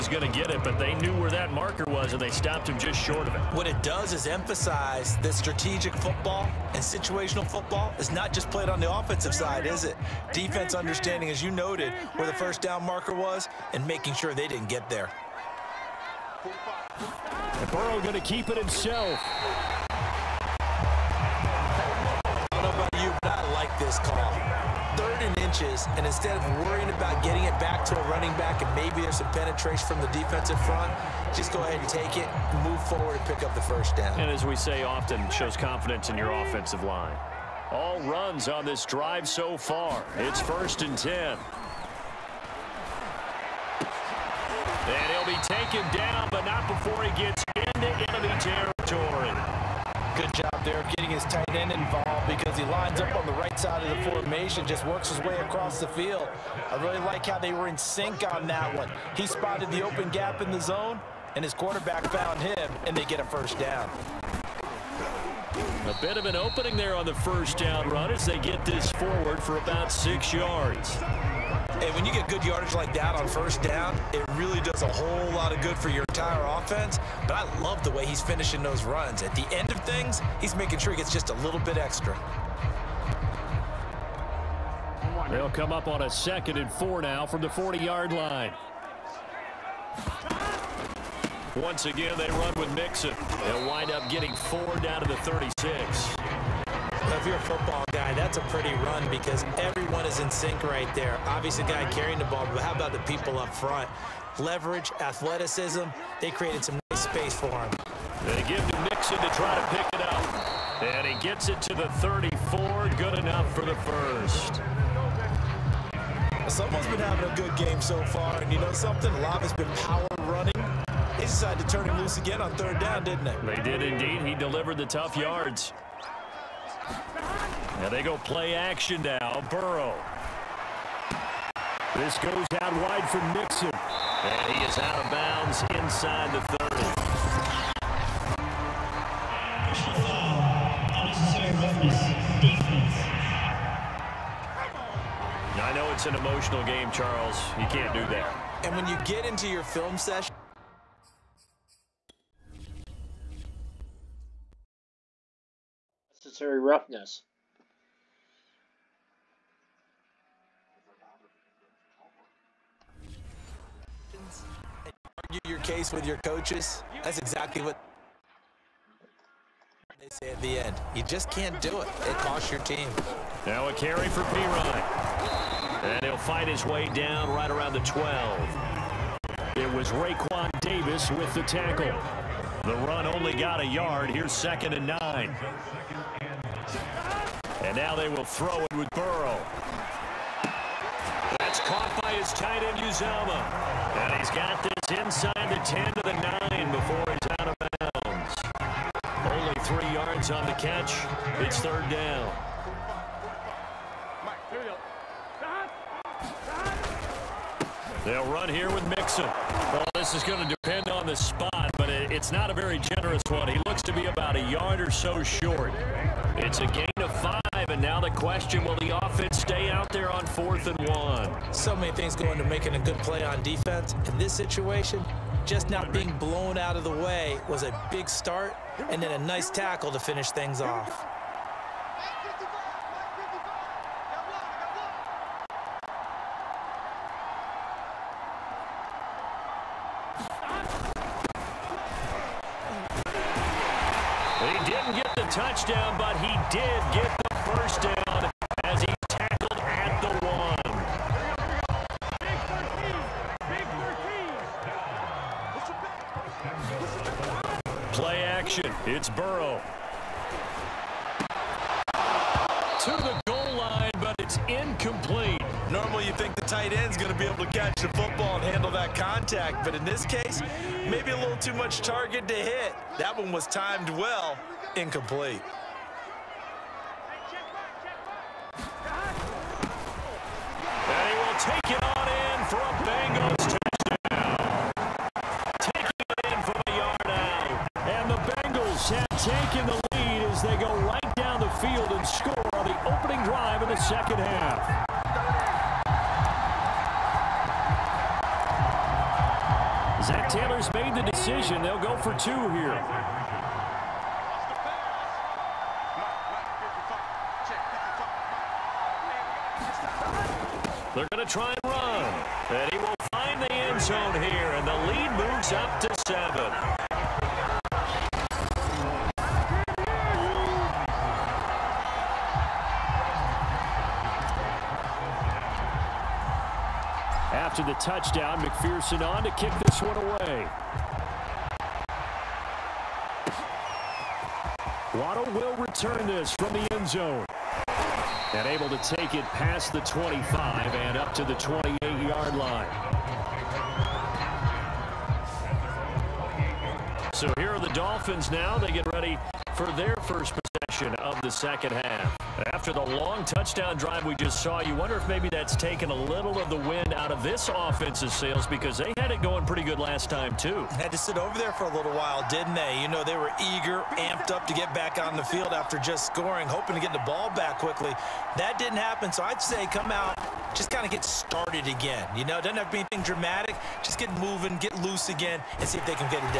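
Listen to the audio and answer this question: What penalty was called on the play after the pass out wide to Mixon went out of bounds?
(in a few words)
unnecessary roughness.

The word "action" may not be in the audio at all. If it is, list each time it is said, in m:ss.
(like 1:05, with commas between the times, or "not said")
2:08, 4:18.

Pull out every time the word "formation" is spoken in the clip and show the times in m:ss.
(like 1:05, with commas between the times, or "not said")
0:54.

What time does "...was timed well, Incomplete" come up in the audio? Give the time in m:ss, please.
4:33.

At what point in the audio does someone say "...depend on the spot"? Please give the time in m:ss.
3:30.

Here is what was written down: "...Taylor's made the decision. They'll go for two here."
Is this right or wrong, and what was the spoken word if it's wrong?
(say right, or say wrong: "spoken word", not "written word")
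right.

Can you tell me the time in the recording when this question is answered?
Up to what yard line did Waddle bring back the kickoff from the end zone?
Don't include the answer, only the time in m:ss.
5:41.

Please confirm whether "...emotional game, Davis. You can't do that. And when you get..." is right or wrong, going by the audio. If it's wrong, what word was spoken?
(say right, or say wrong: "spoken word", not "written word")
wrong: "Charles", not "Davis".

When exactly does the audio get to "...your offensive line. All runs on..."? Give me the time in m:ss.
0:36.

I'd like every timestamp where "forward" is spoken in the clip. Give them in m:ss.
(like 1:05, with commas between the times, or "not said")
0:32, 1:08.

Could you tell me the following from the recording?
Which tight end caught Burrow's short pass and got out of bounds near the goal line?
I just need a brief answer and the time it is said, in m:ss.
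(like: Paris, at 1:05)
Uzomah, at 3:12.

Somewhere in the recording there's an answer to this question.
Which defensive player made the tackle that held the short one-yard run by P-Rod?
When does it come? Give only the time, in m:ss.
2:59.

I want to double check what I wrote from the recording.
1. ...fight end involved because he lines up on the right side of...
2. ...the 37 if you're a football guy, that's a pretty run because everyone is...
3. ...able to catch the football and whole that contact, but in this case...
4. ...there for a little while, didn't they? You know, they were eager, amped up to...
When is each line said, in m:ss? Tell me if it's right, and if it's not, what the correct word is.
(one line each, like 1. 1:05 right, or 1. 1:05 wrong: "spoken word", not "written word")
1. 0:51 wrong: "tight", not "fight"
2. 1:35 wrong: "36", not "37"
3. 4:27 wrong: "handle", not "whole"
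4. 6:01 right.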